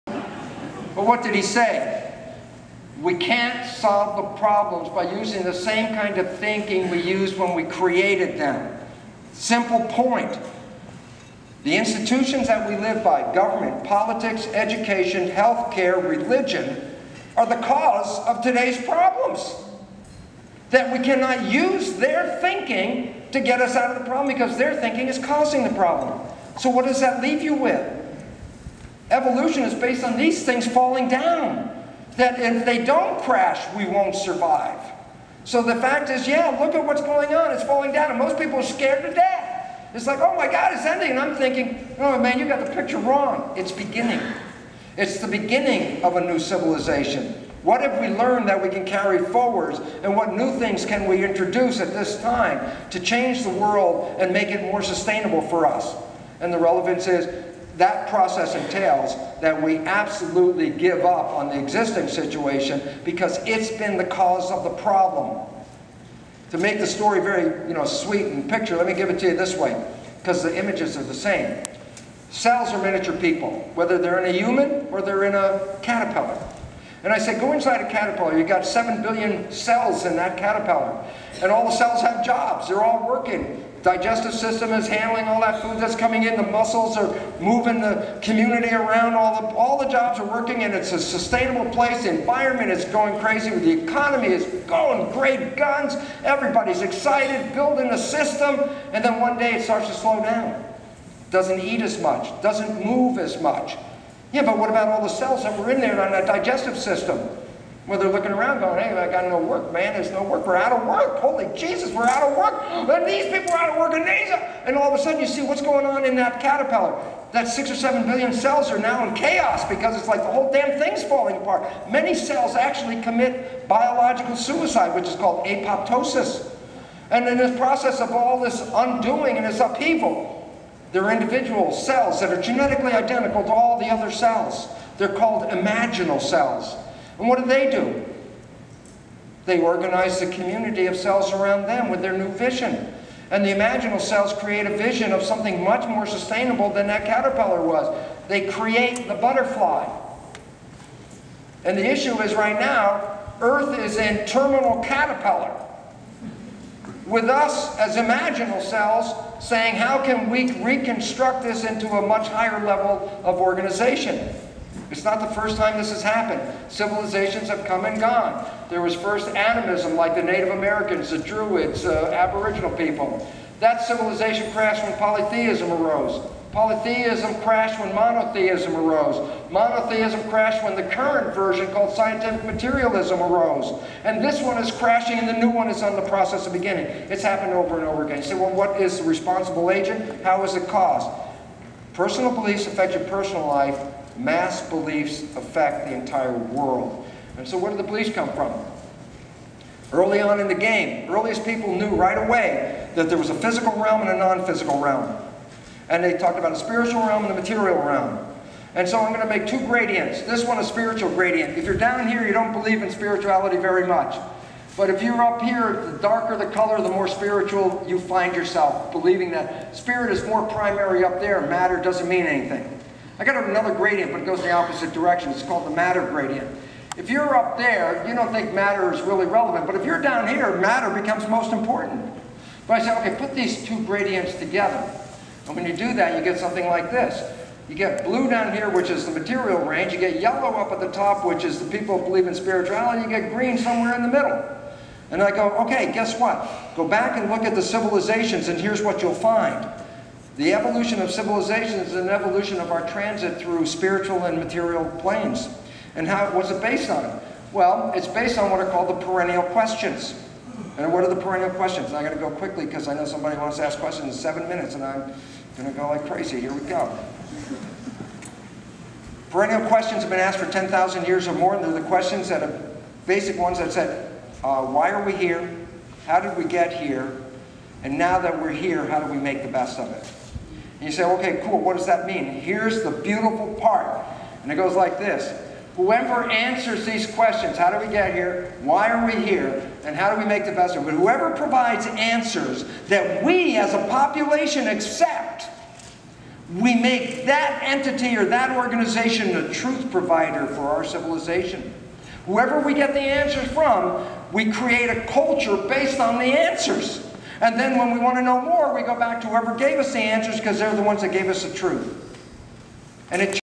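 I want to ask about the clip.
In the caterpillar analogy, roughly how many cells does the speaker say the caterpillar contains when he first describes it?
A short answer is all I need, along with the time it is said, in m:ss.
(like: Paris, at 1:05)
7 billion, at 1:18.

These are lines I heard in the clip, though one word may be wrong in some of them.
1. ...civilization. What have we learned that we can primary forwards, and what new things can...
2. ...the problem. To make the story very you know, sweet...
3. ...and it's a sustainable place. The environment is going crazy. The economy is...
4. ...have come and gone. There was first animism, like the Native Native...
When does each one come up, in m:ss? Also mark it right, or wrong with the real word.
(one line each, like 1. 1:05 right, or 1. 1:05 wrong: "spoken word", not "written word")
1. 0:46 wrong: "carry", not "primary"
2. 1:04 right
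3. 1:30 right
4. 2:47 wrong: "Americans", not "Native".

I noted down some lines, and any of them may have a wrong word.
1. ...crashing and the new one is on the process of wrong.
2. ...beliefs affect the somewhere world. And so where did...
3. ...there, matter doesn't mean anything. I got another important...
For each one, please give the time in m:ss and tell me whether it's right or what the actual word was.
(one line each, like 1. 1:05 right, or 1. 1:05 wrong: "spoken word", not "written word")
1. 3:04 wrong: "beginning", not "wrong"
2. 3:14 wrong: "entire", not "somewhere"
3. 3:41 wrong: "gradient", not "important".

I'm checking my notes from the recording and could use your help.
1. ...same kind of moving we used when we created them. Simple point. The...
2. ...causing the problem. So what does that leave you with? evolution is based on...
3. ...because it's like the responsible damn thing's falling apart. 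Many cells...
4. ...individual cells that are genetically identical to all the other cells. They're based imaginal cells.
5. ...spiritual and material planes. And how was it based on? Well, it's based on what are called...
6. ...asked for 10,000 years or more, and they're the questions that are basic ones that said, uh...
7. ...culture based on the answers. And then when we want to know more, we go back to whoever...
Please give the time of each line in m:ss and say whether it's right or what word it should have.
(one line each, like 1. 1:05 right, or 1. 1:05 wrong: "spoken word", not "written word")
1. 0:05 wrong: "thinking", not "moving"
2. 0:25 right
3. 1:59 wrong: "whole", not "responsible"
4. 2:11 wrong: "called", not "based"
5. 4:13 right
6. 4:30 right
7. 5:05 right.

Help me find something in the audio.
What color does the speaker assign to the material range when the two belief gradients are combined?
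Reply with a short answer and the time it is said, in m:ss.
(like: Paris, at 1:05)
blue, at 3:58.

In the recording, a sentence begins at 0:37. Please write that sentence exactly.
It's falling down, and most people are scared to death.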